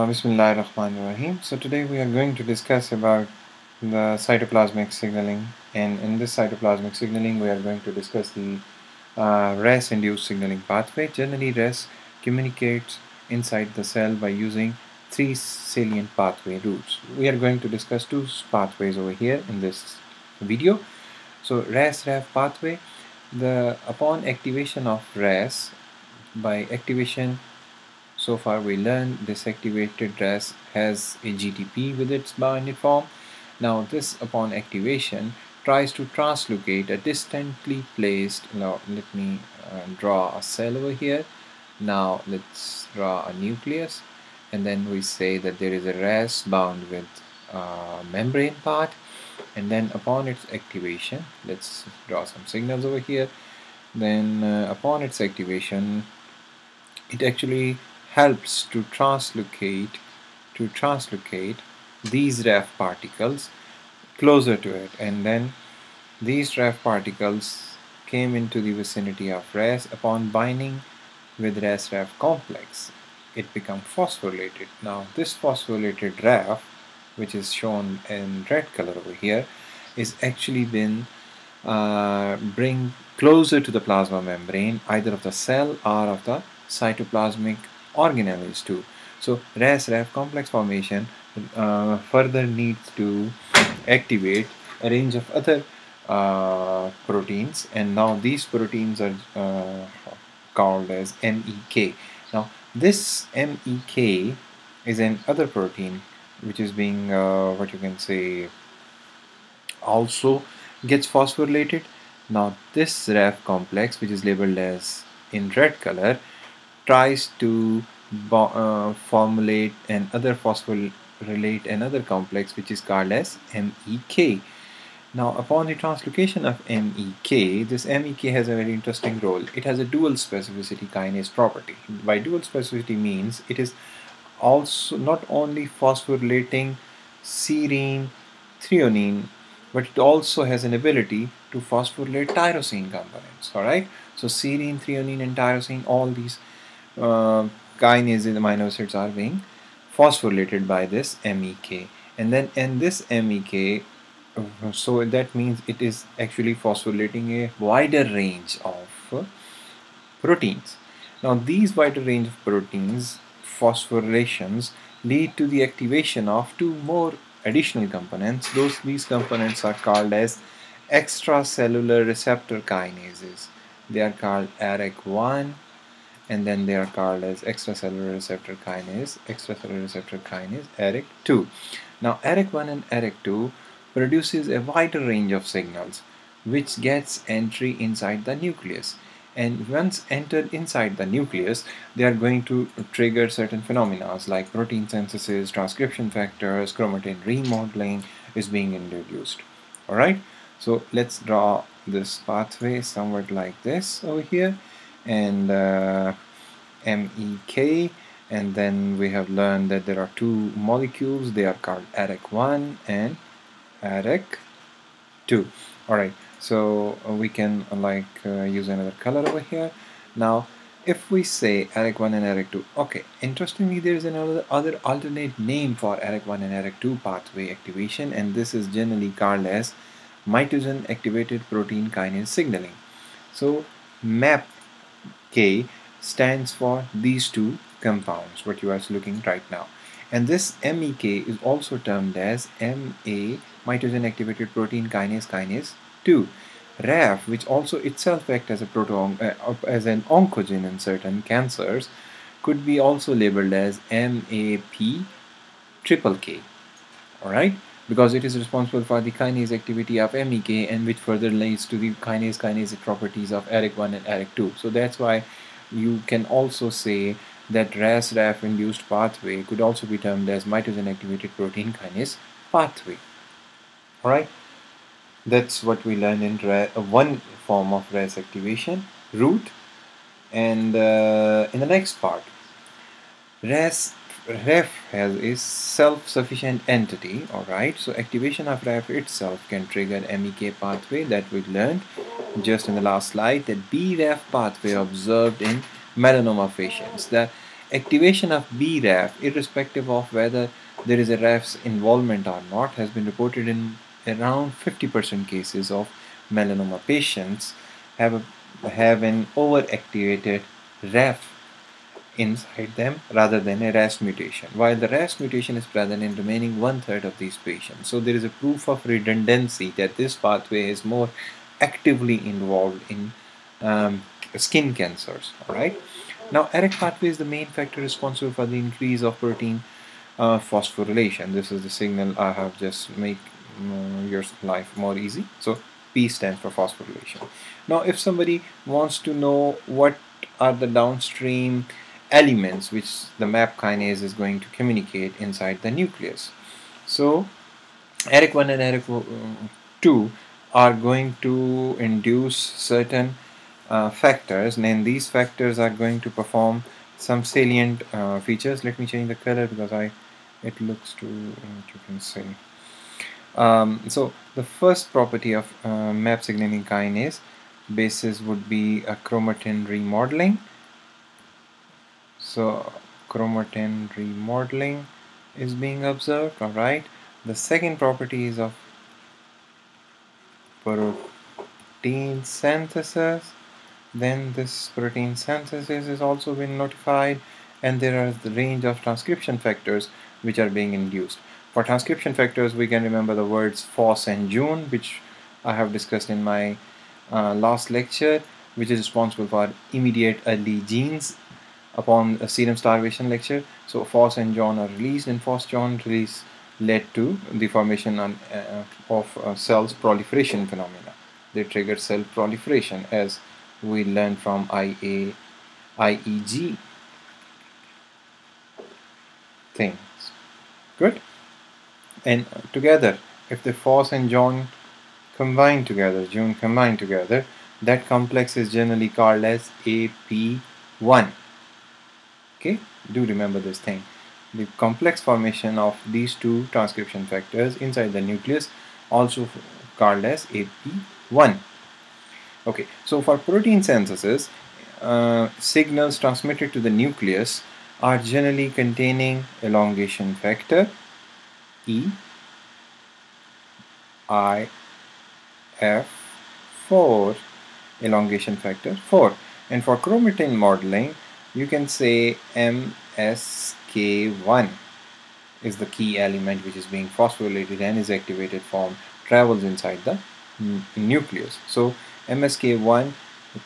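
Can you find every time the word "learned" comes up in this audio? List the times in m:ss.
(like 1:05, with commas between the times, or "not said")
0:28, 3:29, 4:35, 4:51, 6:53.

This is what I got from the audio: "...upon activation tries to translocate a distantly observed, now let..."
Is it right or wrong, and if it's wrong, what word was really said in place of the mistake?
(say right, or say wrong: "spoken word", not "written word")
wrong: "placed", not "observed".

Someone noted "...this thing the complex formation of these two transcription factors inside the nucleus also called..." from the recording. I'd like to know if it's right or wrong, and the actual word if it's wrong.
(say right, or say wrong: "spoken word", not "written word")
right.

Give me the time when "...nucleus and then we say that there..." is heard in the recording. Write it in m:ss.
0:43.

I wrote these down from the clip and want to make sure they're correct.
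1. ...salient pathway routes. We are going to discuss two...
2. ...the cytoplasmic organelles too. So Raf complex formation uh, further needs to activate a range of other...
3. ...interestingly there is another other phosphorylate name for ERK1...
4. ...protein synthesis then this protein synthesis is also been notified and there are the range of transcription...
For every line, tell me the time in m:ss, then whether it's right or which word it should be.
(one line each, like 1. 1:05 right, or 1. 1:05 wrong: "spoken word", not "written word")
1. 0:15 right
2. 1:26 right
3. 3:43 wrong: "alternate", not "phosphorylate"
4. 6:20 right.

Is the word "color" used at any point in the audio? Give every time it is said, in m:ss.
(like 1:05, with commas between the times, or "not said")
1:18, 1:55, 3:38, 5:59.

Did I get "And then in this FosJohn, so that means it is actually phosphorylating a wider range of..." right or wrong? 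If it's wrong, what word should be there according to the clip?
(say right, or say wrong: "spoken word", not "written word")
wrong: "MEK", not "FosJohn".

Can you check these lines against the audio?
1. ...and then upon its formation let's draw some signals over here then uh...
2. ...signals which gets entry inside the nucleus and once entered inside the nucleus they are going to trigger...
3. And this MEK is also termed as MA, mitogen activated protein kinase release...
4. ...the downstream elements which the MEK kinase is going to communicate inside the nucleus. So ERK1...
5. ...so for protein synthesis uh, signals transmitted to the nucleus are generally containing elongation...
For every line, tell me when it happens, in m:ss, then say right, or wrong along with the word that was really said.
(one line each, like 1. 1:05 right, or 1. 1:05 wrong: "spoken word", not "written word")
1. 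0:49 wrong: "activation", not "formation"
2. 3:05 right
3. 4:00 wrong: "kinase", not "release"
4. 5:40 wrong: "MAP", not "MEK"
5. 7:22 right.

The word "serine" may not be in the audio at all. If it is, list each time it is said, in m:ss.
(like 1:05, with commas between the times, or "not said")
2:17, 2:24.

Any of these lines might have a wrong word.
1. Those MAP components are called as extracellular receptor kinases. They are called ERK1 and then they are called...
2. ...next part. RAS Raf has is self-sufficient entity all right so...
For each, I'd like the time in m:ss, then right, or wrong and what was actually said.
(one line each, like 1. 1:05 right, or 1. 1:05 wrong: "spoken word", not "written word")
1. 2:48 wrong: "These", not "MAP"
2. 4:41 right.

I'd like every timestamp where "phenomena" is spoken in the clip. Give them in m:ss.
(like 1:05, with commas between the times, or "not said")
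3:13, 6:50.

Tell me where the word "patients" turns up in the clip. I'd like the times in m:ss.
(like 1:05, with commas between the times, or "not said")
4:56, 5:06, 5:17.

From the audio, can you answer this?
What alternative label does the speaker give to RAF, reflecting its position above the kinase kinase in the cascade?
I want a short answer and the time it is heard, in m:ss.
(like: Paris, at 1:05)
MAP triple K, at 4:13.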